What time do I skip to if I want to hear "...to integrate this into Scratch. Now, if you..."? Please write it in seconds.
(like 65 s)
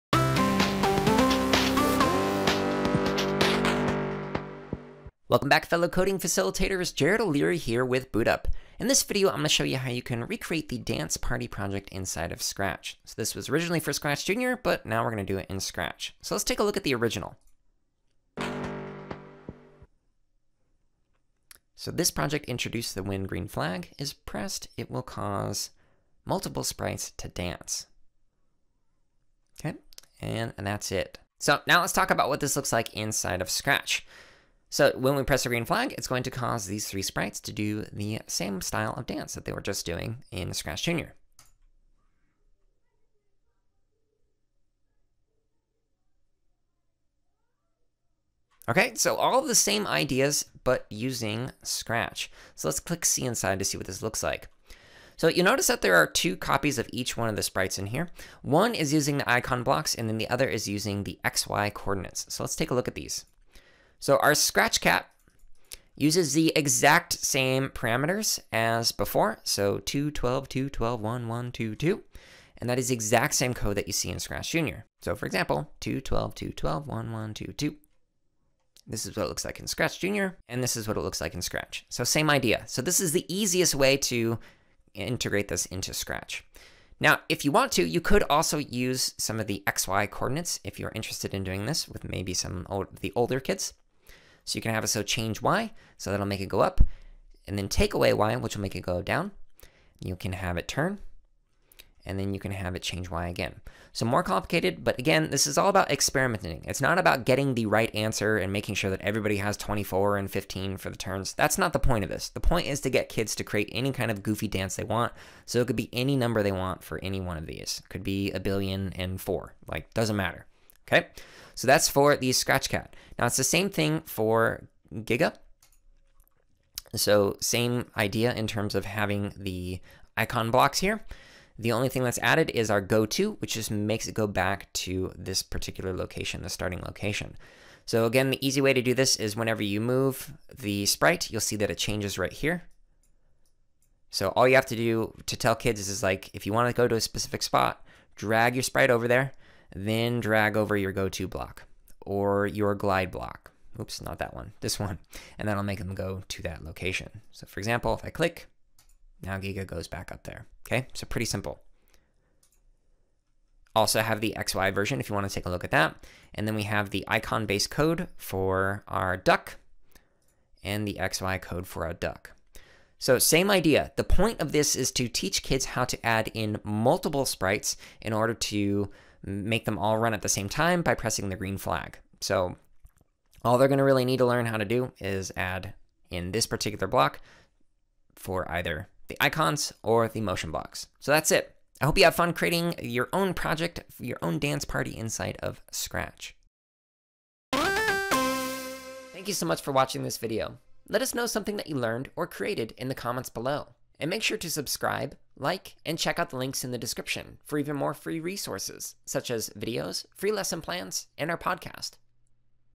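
83 s.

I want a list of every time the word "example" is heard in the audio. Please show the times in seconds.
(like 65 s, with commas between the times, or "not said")
75 s, 157 s.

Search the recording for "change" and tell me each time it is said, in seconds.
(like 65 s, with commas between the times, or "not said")
95 s, 102 s, 141 s.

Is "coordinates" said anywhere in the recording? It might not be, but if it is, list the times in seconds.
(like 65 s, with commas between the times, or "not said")
61 s, 90 s.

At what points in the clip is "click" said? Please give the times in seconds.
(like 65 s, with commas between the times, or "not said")
52 s, 158 s.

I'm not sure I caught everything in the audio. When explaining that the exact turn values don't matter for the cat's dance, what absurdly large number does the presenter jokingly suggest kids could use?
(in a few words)
a billion and four.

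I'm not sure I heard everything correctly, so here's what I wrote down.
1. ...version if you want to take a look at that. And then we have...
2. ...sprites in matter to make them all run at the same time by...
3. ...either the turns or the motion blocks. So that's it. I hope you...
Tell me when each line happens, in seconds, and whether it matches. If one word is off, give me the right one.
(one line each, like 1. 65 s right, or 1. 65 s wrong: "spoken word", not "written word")
1. 164 s right
2. 177 s wrong: "order", not "matter"
3. 188 s wrong: "icons", not "turns".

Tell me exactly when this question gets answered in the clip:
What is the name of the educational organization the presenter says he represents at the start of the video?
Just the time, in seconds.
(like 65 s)
8 s.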